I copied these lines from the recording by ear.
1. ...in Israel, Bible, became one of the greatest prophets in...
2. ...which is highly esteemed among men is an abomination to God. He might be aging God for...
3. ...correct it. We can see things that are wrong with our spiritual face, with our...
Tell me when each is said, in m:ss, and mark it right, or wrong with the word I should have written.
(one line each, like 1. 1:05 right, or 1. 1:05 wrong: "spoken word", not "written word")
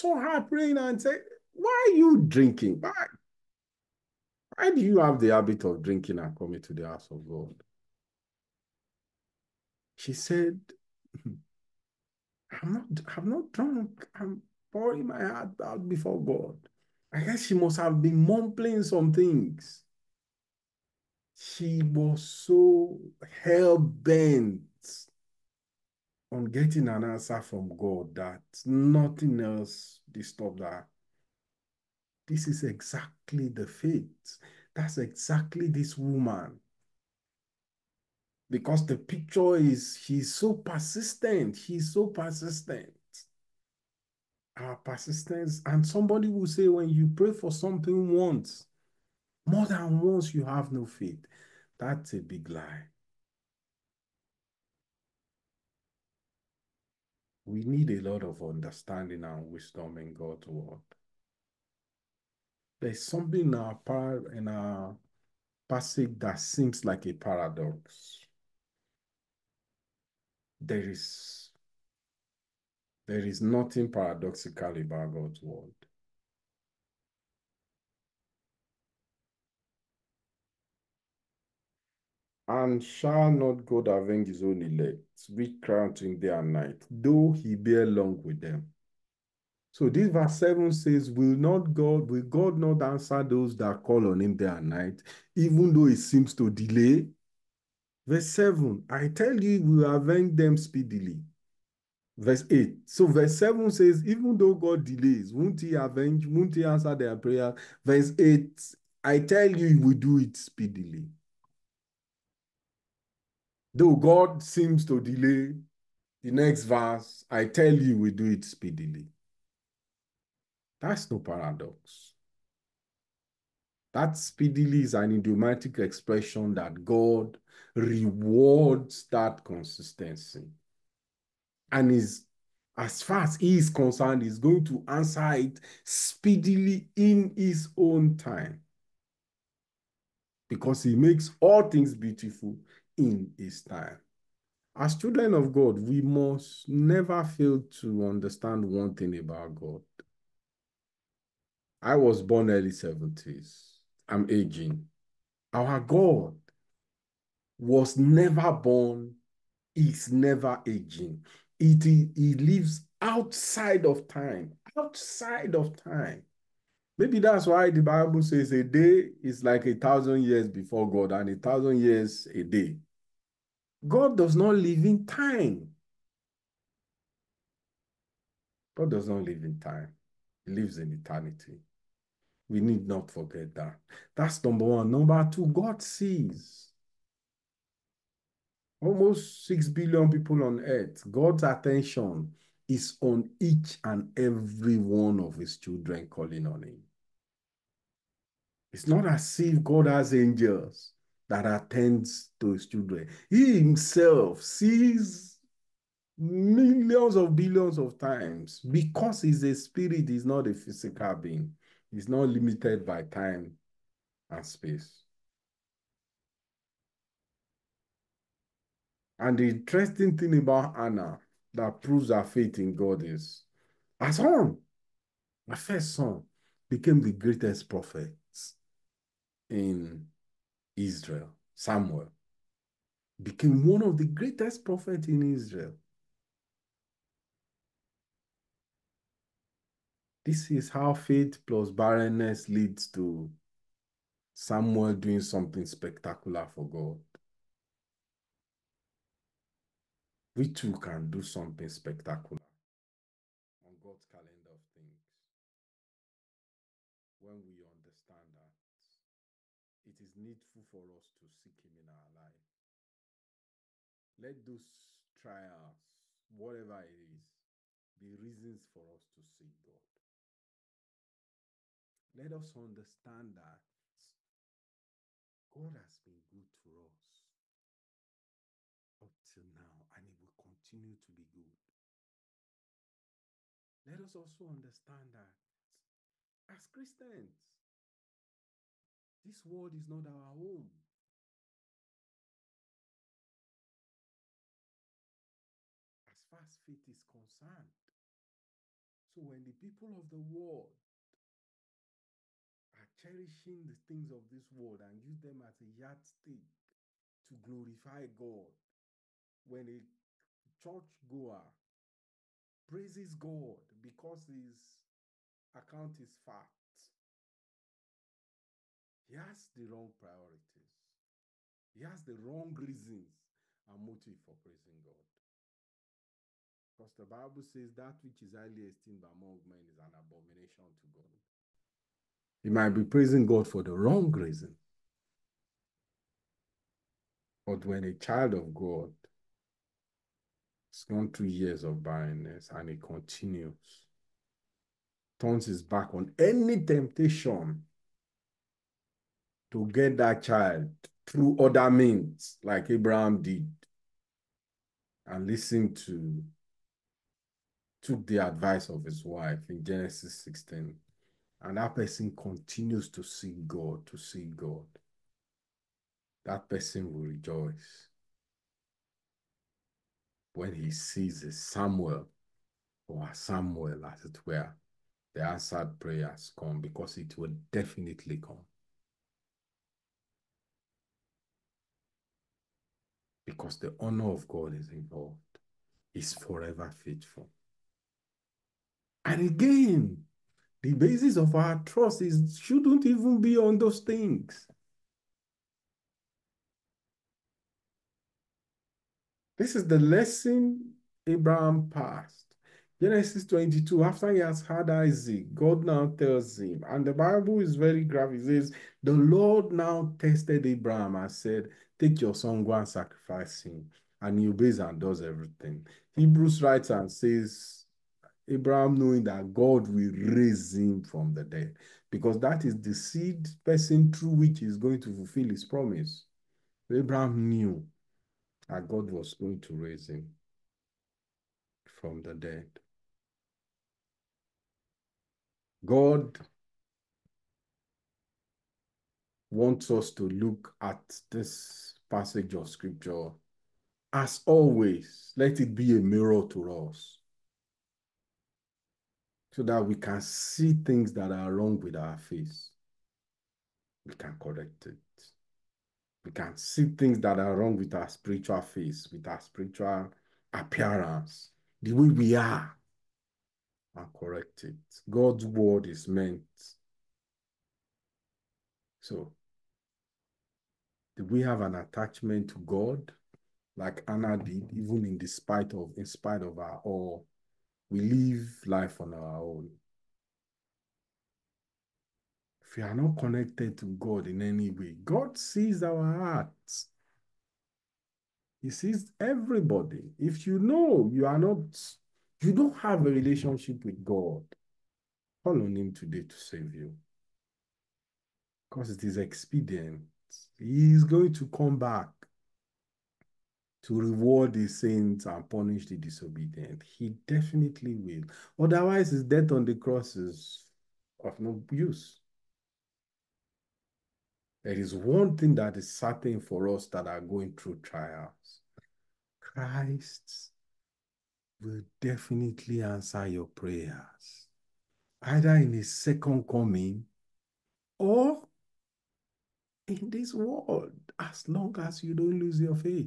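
1. 3:49 wrong: "Samuel", not "Bible"
2. 5:28 wrong: "praising", not "aging"
3. 7:34 right.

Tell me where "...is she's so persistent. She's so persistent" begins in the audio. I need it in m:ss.
0:39.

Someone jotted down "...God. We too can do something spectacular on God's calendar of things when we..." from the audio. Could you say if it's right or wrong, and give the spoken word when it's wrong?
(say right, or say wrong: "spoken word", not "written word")
right.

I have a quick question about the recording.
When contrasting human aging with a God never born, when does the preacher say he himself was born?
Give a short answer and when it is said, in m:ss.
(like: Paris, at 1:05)
early 70s, at 2:32.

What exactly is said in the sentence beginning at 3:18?
It's not as if God has angels that attends to his children.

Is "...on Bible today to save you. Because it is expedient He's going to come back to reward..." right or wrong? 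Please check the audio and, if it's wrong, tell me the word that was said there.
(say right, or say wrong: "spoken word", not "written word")
wrong: "Him", not "Bible".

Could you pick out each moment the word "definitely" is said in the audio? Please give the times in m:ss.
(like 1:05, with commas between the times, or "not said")
6:17, 8:27, 8:41.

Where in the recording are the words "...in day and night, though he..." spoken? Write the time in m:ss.
1:26.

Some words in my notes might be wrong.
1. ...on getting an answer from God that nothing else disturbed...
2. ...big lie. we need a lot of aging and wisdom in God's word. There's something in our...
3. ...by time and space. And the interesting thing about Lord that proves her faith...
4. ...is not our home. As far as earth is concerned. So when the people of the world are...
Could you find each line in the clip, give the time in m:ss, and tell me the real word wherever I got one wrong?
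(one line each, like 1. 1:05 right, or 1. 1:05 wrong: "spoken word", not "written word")
1. 0:26 right
2. 0:52 wrong: "understanding", not "aging"
3. 3:32 wrong: "Anna", not "Lord"
4. 4:49 wrong: "faith", not "earth".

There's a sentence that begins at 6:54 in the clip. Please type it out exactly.
And he obeys and does everything.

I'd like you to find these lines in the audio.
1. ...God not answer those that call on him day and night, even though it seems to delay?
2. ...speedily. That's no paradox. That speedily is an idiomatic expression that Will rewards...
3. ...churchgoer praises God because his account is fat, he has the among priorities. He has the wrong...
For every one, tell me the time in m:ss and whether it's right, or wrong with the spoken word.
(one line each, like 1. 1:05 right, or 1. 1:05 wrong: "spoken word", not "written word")
1. 1:32 right
2. 1:58 wrong: "God", not "Will"
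3. 5:10 wrong: "wrong", not "among".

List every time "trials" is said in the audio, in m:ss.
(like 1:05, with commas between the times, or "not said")
4:25, 8:37.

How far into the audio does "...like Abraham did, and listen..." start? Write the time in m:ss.
5:52.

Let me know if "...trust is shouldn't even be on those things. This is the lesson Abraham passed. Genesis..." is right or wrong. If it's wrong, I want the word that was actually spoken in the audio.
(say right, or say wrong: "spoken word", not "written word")
right.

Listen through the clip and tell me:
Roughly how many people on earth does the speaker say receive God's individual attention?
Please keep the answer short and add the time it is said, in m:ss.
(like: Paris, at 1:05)
6 billion, at 3:09.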